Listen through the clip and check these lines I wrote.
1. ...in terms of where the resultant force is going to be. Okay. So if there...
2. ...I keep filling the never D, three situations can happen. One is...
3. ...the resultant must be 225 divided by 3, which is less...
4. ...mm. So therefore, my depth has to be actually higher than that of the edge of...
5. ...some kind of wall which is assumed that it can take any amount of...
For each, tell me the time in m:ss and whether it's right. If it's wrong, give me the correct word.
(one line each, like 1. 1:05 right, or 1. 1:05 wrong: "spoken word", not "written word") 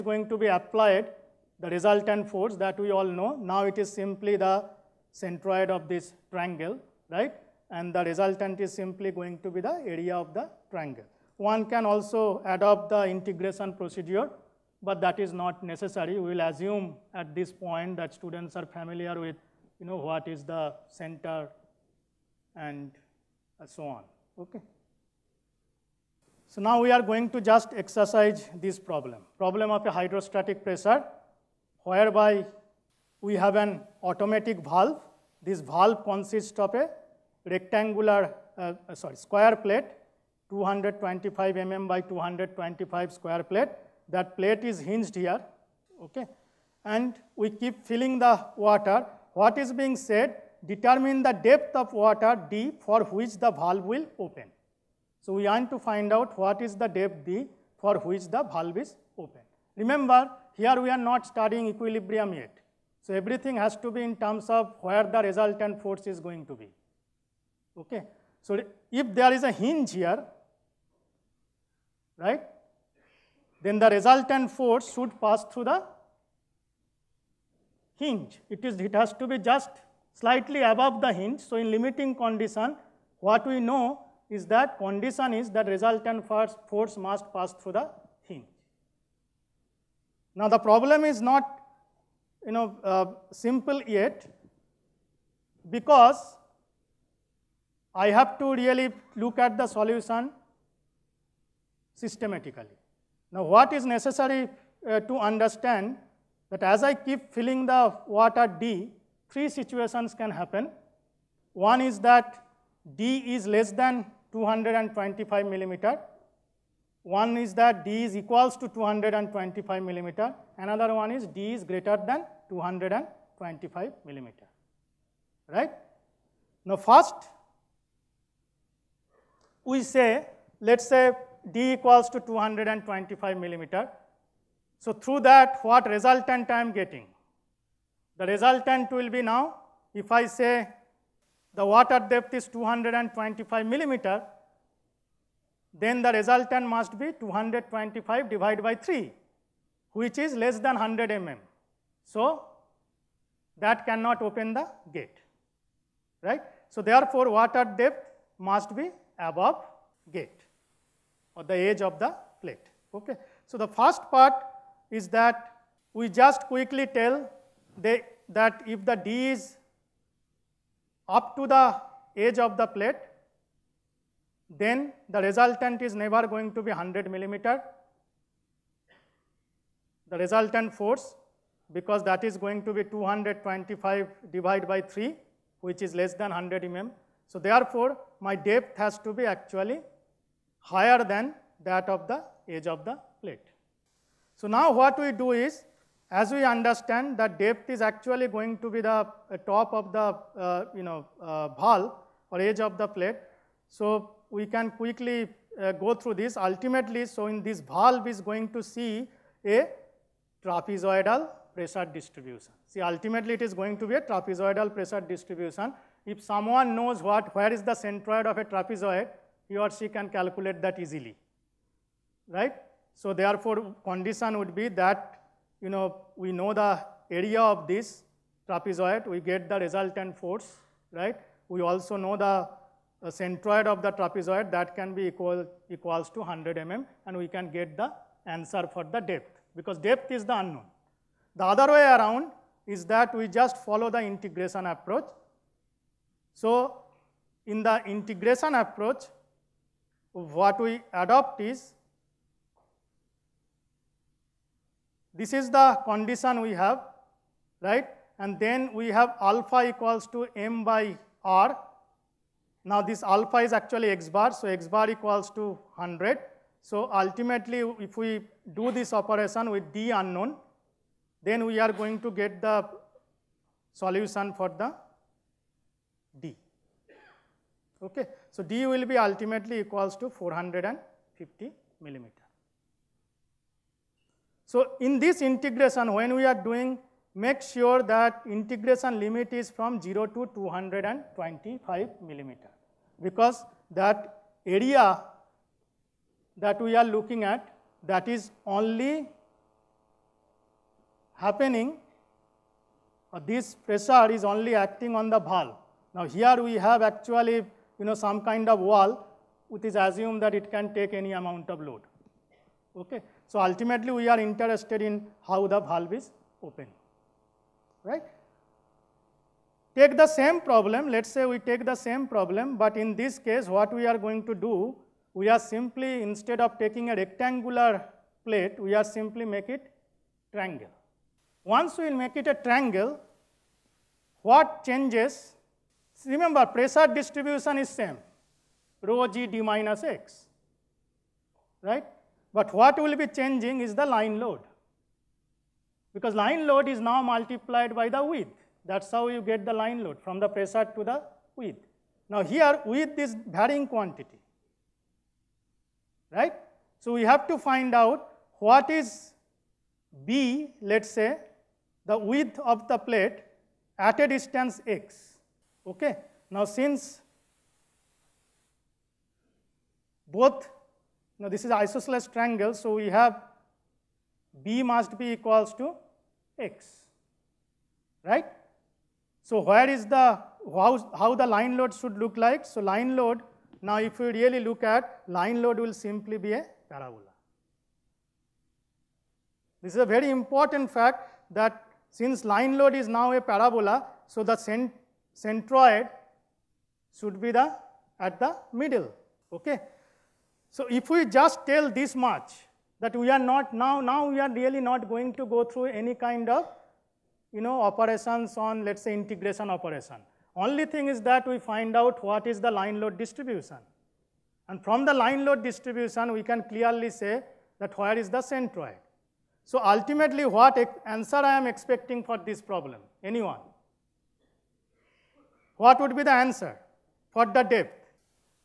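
1. 1:04 right
2. 1:46 wrong: "water", not "never"
3. 2:26 right
4. 3:06 right
5. 5:07 right.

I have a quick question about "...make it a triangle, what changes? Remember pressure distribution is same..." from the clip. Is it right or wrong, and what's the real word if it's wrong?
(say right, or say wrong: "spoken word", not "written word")
right.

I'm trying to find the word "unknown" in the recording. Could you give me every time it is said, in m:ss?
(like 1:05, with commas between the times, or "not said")
4:00, 4:29.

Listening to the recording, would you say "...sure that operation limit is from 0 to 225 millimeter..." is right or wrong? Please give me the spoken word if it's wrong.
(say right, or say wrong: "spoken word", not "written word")
wrong: "integration", not "operation".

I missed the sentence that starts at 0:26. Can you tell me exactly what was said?
So now we are going to just exercise this problem, problem of a hydrostatic pressure whereby we have an automatic valve.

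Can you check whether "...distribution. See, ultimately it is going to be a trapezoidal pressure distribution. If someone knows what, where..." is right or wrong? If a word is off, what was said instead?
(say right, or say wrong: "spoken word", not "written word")
right.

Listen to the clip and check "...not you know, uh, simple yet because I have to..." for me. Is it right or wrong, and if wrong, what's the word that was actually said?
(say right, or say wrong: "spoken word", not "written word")
right.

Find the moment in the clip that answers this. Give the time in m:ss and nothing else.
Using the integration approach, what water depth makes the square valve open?
4:40.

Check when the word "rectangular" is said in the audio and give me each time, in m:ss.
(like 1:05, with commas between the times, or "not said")
0:37, 5:26.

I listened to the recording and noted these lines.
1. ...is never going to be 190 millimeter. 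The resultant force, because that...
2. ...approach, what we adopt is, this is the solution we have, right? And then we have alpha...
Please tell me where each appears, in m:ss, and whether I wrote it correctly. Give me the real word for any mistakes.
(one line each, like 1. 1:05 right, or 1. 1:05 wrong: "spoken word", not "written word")
1. 2:55 wrong: "100", not "190"
2. 4:08 wrong: "condition", not "solution".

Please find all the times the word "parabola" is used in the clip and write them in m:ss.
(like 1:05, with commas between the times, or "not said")
6:26, 6:33.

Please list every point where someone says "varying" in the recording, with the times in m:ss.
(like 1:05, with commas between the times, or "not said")
5:53.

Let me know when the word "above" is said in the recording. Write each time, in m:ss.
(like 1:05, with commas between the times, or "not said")
1:20, 2:39.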